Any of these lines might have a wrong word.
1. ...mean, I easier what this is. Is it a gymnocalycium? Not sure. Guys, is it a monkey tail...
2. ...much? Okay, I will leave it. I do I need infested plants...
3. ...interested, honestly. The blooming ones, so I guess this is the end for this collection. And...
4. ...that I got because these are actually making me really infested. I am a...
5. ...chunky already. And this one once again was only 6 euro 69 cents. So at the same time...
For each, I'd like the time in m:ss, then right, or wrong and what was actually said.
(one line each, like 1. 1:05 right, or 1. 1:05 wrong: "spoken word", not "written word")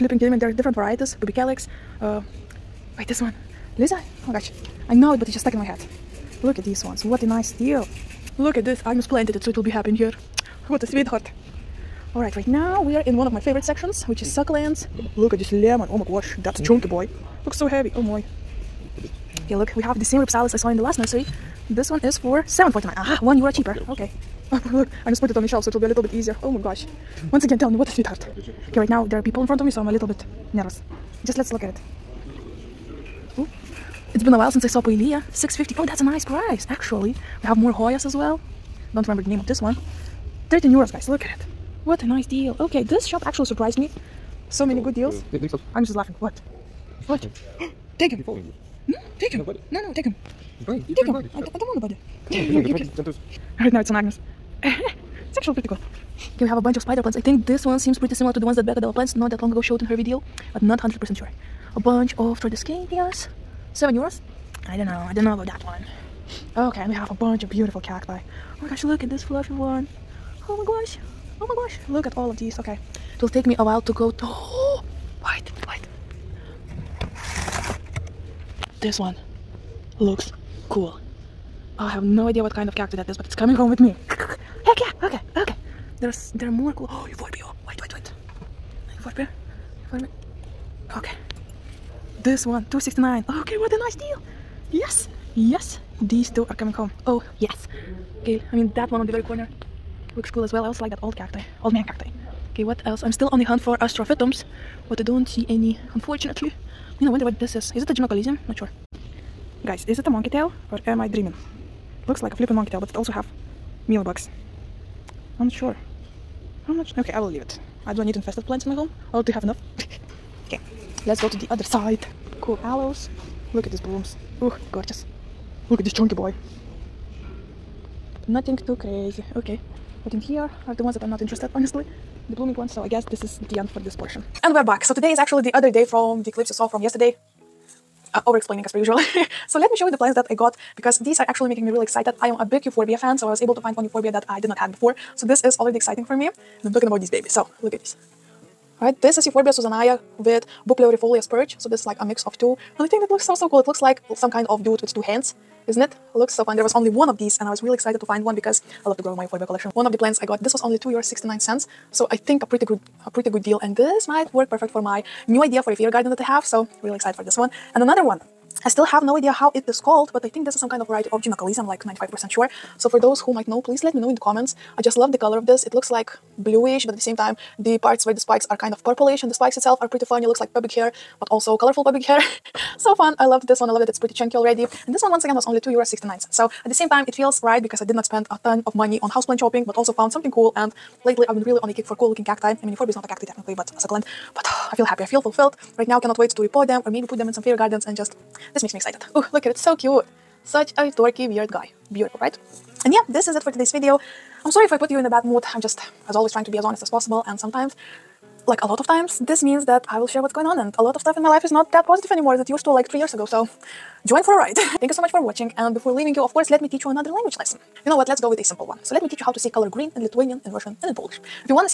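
1. 1:47 wrong: "wonder", not "easier"
2. 1:56 right
3. 2:11 wrong: "portion", not "collection"
4. 2:20 wrong: "excited", not "infested"
5. 3:04 wrong: "2", not "6".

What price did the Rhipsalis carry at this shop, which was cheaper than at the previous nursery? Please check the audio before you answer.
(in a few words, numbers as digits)
7.49.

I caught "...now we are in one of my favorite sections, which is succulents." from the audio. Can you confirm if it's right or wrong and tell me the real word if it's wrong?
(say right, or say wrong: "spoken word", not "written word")
right.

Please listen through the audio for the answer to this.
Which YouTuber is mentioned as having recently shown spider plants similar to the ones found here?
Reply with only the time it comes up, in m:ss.
0:58.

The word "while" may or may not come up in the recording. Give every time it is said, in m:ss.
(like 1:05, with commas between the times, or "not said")
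0:34, 1:13.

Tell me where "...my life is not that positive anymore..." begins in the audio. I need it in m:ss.
3:31.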